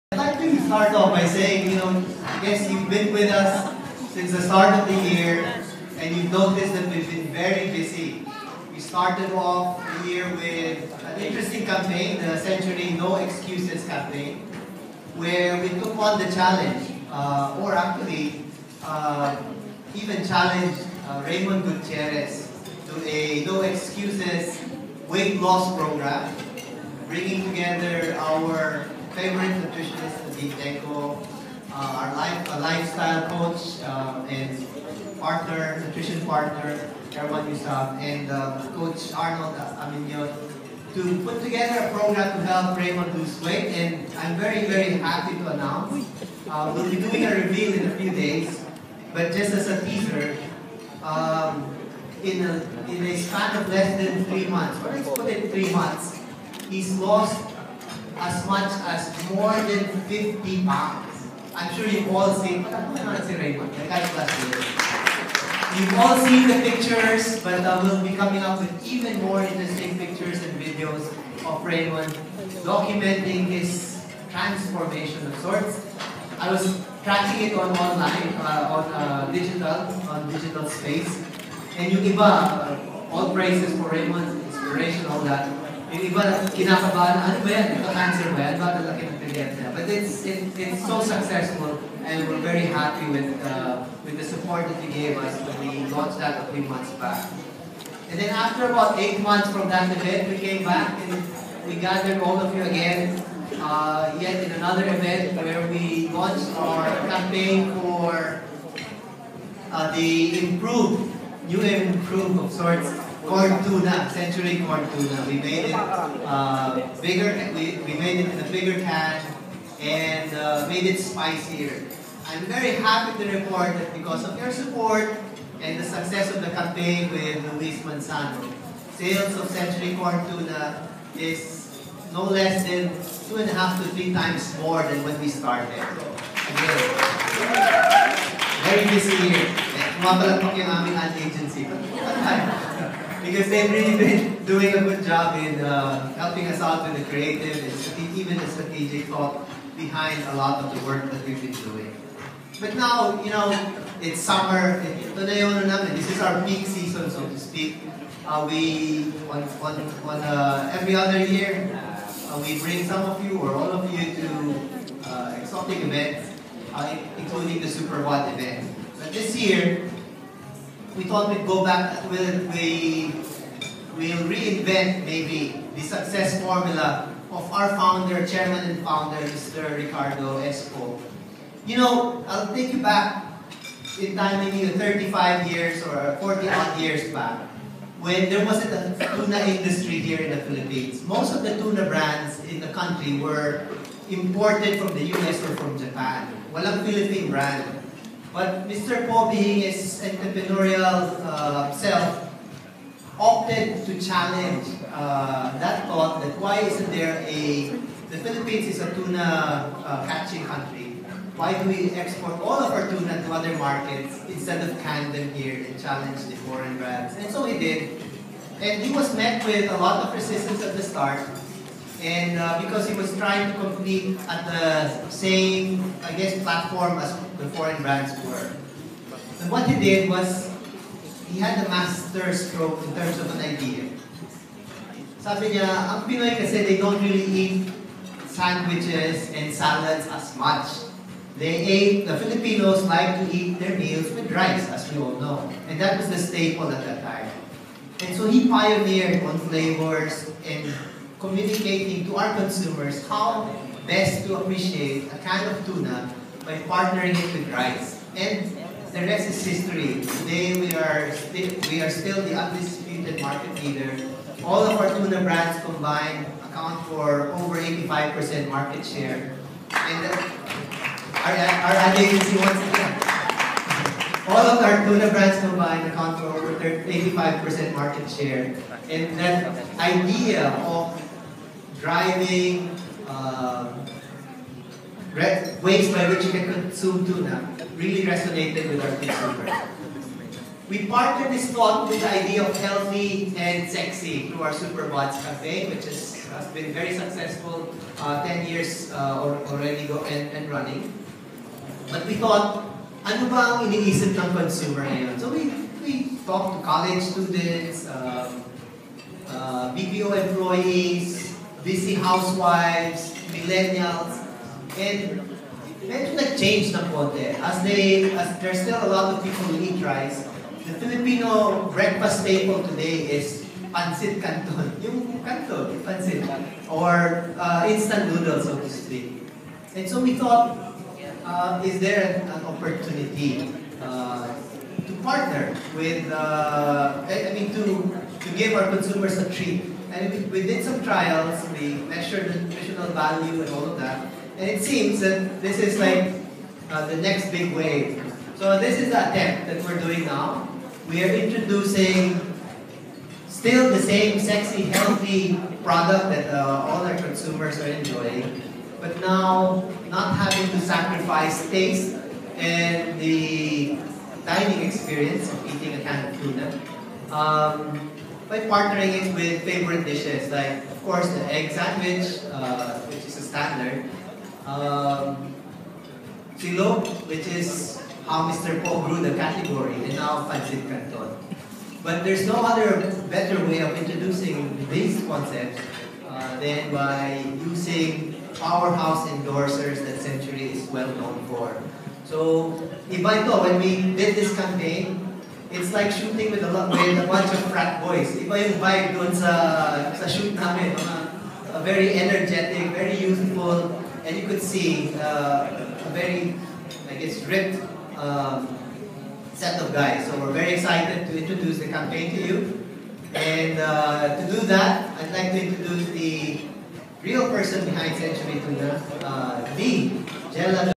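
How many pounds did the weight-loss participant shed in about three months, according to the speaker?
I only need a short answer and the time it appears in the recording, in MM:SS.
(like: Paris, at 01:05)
more than 50 pounds, at 00:59.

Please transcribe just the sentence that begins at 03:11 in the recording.
Most of the tuna brands in the country were imported from the US or from Japan.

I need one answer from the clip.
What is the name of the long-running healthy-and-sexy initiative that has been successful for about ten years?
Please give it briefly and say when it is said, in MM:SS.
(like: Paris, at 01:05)
Superbods Cafe, at 04:54.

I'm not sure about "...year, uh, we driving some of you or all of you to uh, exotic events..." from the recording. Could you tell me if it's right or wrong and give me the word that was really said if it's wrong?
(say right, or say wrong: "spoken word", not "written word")
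wrong: "bring", not "driving".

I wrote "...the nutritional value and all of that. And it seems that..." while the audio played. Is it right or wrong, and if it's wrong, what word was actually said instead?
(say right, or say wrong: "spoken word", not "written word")
right.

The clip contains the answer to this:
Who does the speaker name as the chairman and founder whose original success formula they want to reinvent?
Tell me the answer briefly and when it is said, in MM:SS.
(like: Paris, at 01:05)
Ricardo S. Po, at 02:59.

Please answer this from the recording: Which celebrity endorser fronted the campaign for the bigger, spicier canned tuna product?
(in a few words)
Luis Manzano.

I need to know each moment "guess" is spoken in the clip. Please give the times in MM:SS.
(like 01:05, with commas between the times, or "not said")
03:46, 06:46.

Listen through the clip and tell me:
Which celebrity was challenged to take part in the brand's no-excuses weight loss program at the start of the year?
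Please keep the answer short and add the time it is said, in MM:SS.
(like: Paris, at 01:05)
Raymond Gutierrez, at 00:21.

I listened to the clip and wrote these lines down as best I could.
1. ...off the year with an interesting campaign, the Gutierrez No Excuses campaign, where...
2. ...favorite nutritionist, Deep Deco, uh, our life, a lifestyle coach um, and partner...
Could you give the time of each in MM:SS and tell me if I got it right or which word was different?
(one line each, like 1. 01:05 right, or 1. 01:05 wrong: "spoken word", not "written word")
1. 00:09 wrong: "Century", not "Gutierrez"
2. 00:29 right.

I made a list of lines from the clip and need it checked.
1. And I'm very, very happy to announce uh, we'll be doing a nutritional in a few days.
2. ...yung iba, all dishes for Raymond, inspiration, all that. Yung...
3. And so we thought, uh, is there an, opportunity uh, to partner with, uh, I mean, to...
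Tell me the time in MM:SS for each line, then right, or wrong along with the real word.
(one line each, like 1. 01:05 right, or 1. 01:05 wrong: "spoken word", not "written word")
1. 00:43 wrong: "reveal", not "nutritional"
2. 01:21 wrong: "praises", not "dishes"
3. 05:29 right.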